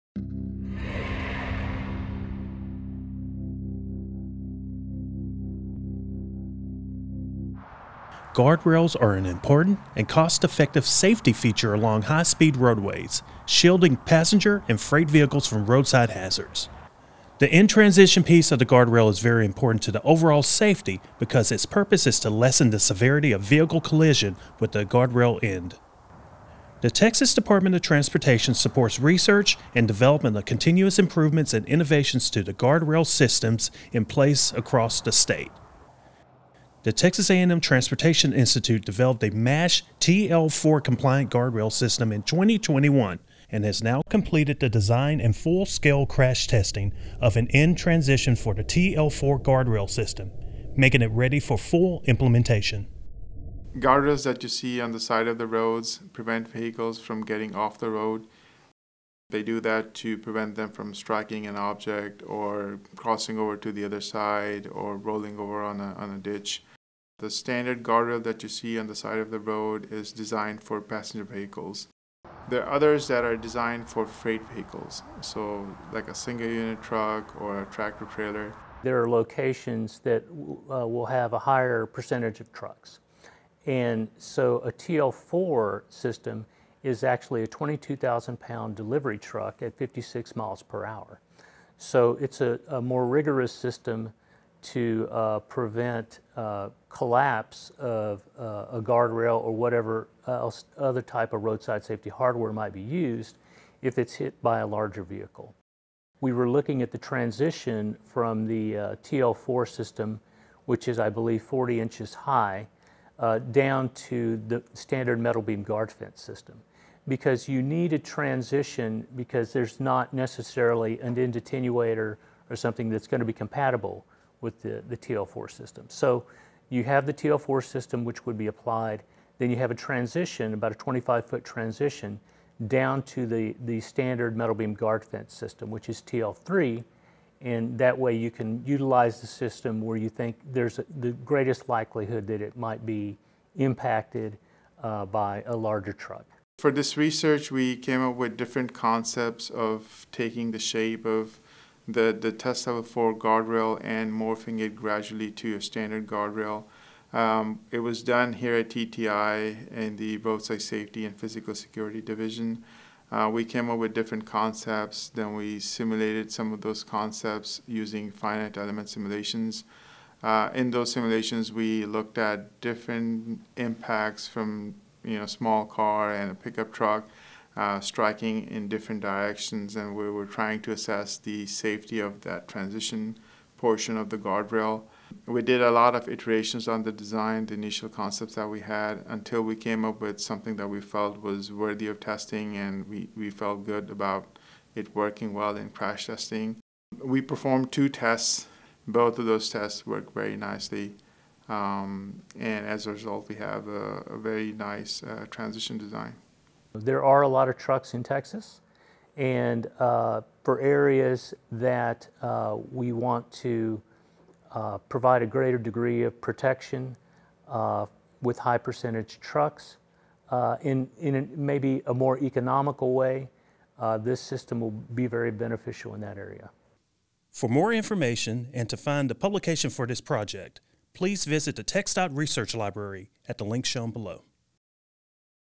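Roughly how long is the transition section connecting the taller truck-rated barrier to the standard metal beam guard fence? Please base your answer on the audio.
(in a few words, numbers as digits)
25 feet.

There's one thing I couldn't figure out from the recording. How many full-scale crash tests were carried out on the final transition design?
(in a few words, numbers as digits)
2.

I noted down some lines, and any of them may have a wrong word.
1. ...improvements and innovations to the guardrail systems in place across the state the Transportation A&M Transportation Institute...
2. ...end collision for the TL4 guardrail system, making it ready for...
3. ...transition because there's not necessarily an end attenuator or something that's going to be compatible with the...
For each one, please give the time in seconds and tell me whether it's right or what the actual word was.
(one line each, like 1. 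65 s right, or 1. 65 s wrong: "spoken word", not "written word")
1. 30 s wrong: "Texas", not "Transportation"
2. 47 s wrong: "transition", not "collision"
3. 117 s right.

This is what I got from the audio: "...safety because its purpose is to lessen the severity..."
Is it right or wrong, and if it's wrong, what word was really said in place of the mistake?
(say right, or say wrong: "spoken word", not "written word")
right.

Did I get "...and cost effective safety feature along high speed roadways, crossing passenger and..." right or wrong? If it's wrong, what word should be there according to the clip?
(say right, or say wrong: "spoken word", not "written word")
wrong: "shielding", not "crossing".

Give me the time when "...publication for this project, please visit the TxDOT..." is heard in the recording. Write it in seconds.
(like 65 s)
229 s.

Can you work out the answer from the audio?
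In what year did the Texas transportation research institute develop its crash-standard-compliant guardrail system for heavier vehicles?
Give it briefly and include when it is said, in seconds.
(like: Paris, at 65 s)
2021, at 42 s.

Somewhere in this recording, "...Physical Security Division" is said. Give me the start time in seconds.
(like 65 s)
161 s.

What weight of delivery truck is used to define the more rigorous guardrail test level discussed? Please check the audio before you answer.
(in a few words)
22,000 pounds.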